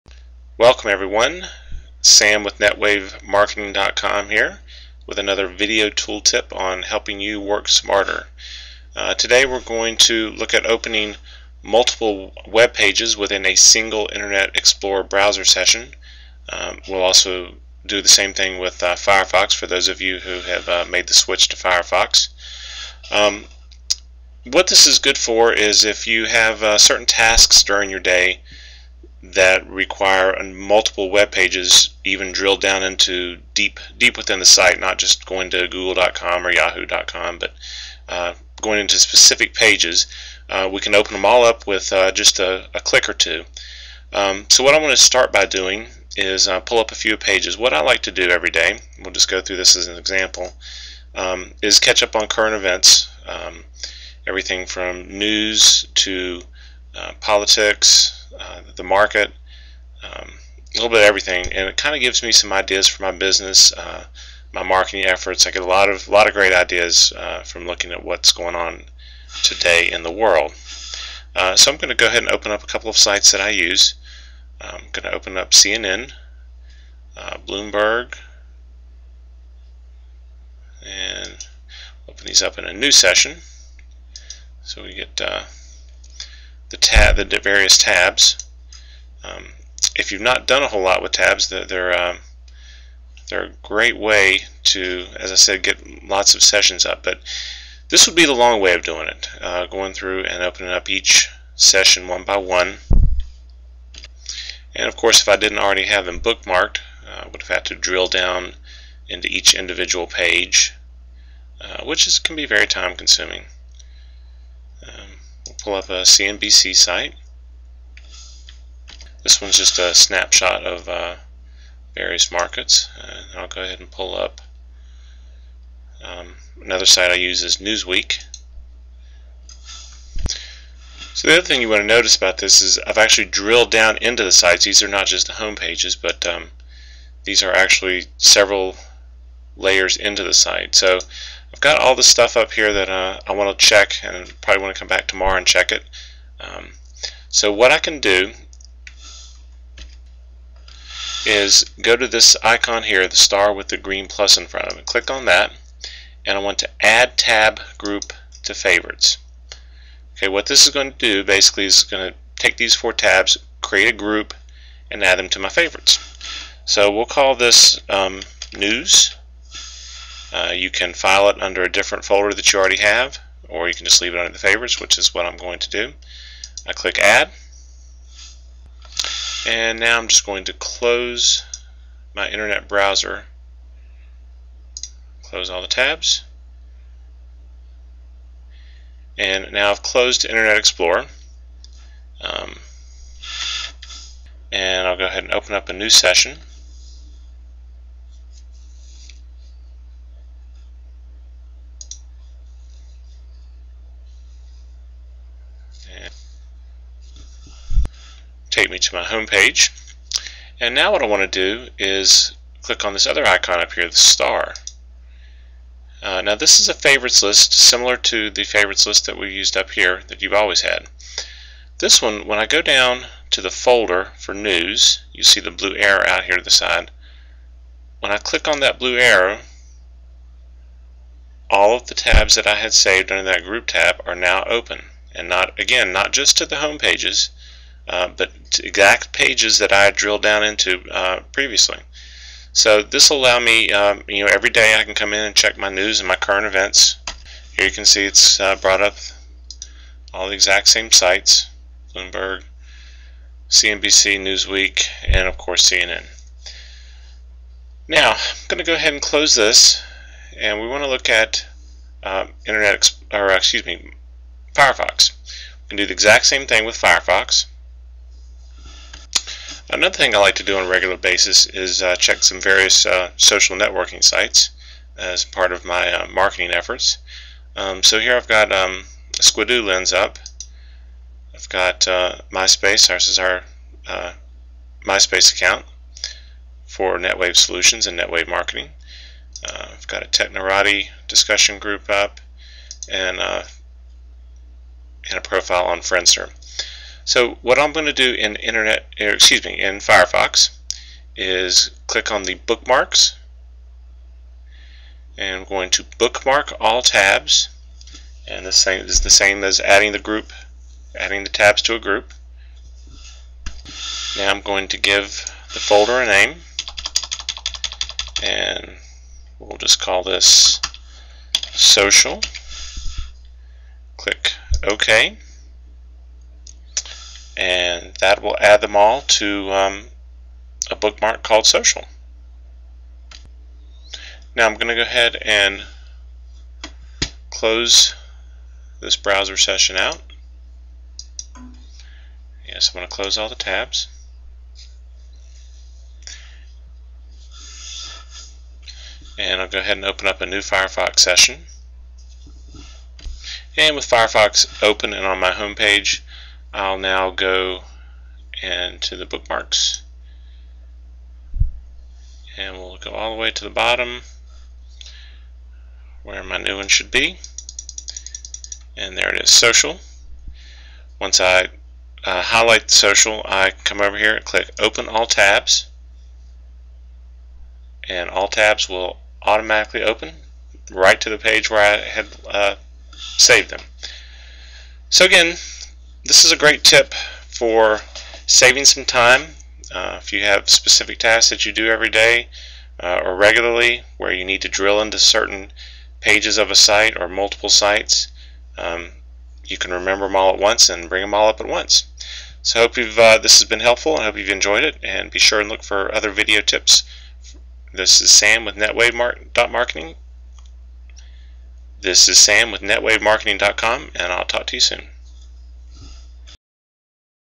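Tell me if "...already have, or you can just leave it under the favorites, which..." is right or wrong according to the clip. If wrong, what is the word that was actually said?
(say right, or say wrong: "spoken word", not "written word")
right.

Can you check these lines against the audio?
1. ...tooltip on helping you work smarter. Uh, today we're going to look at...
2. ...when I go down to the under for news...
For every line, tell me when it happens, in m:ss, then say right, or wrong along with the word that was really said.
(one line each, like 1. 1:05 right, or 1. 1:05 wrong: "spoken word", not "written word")
1. 0:05 right
2. 3:42 wrong: "folder", not "under".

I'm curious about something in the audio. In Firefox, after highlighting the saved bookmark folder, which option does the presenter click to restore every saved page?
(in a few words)
open all tabs.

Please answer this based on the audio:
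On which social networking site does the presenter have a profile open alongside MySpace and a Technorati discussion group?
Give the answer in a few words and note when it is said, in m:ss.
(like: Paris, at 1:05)
Friendster, at 4:55.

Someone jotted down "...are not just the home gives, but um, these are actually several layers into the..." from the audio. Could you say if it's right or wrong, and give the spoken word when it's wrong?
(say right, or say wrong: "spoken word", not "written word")
wrong: "pages", not "gives".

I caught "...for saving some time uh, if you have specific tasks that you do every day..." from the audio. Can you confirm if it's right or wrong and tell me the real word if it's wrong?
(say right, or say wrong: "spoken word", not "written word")
right.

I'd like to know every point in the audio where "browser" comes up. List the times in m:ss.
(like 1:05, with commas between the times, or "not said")
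0:15, 3:02, 5:38.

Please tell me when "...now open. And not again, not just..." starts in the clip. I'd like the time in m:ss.
3:54.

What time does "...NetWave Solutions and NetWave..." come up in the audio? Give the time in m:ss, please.
4:46.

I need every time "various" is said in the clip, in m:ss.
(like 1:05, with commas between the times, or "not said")
1:27, 2:01, 4:32.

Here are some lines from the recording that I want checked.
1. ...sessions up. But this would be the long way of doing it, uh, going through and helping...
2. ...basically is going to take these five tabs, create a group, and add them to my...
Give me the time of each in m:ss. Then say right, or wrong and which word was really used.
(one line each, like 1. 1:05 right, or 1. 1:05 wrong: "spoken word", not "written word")
1. 1:36 wrong: "opening", not "helping"
2. 2:41 wrong: "four", not "five".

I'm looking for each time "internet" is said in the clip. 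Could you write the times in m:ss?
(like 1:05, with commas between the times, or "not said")
0:14, 3:02, 3:10, 4:22, 4:58.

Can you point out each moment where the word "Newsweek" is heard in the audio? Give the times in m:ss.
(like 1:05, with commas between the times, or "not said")
2:07, 4:14.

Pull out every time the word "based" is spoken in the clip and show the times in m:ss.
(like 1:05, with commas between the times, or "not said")
not said.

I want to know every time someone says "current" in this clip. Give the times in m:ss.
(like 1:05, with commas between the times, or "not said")
0:52, 4:06.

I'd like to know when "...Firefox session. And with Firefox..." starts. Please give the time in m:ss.
5:50.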